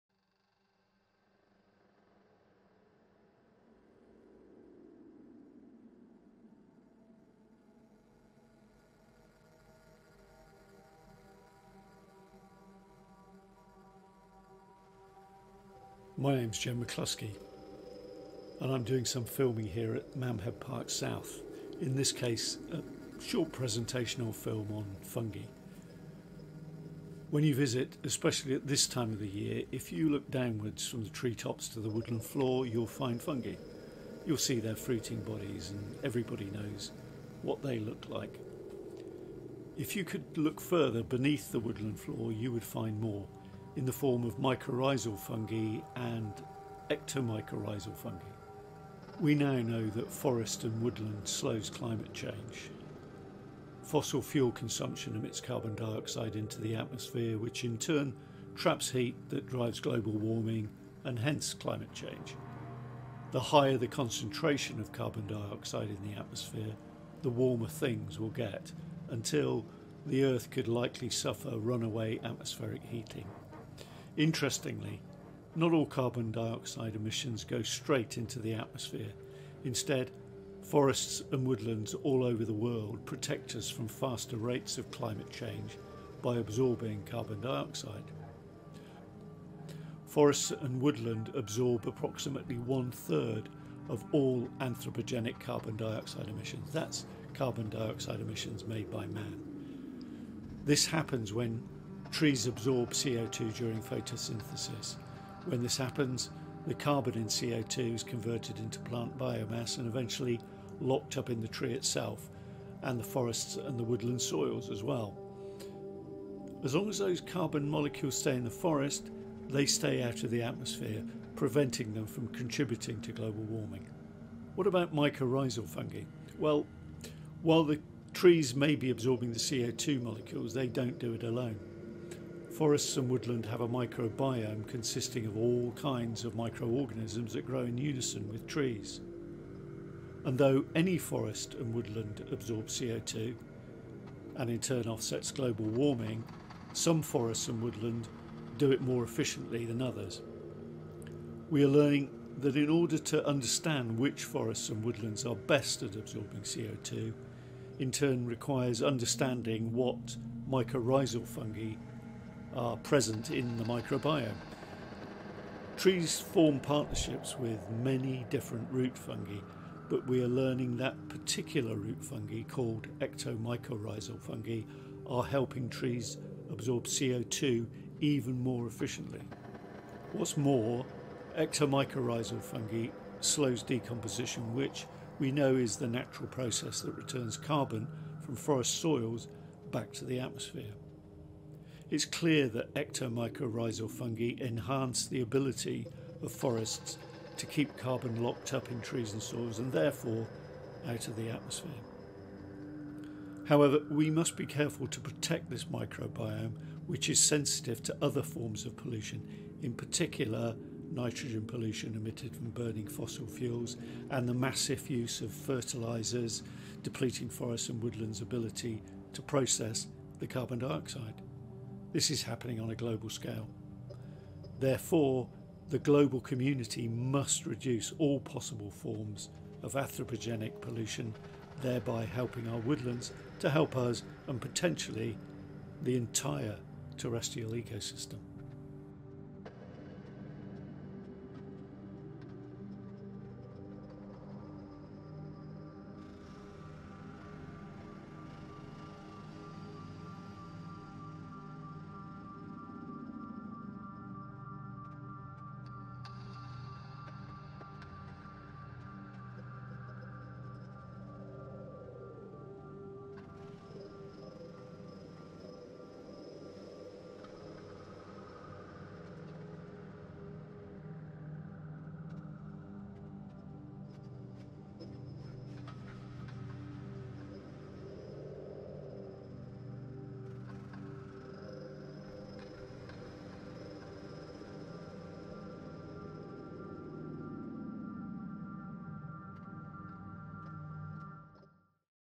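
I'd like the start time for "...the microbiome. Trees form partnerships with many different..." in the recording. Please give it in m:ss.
2:43.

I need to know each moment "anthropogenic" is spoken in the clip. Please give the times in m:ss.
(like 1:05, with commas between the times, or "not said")
1:34, 3:49.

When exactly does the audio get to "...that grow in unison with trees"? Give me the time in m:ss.
2:17.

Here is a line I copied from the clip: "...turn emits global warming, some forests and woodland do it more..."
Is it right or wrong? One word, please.
wrong.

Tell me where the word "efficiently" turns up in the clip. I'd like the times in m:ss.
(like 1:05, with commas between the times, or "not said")
2:29, 2:58.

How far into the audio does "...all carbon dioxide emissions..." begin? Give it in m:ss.
1:15.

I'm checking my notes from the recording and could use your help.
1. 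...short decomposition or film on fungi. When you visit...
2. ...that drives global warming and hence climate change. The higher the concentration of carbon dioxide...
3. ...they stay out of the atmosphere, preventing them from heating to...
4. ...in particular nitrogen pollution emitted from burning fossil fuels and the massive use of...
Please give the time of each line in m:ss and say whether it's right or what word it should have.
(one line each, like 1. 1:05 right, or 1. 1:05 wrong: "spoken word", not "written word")
1. 0:23 wrong: "presentation", not "decomposition"
2. 0:59 right
3. 1:59 wrong: "contributing", not "heating"
4. 3:29 right.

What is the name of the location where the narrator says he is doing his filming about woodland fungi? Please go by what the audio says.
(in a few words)
Mamhead Park South.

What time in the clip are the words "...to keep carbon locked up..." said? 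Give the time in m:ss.
3:17.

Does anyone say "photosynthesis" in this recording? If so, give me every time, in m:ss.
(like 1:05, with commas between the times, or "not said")
1:43.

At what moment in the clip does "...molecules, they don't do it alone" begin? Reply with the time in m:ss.
2:10.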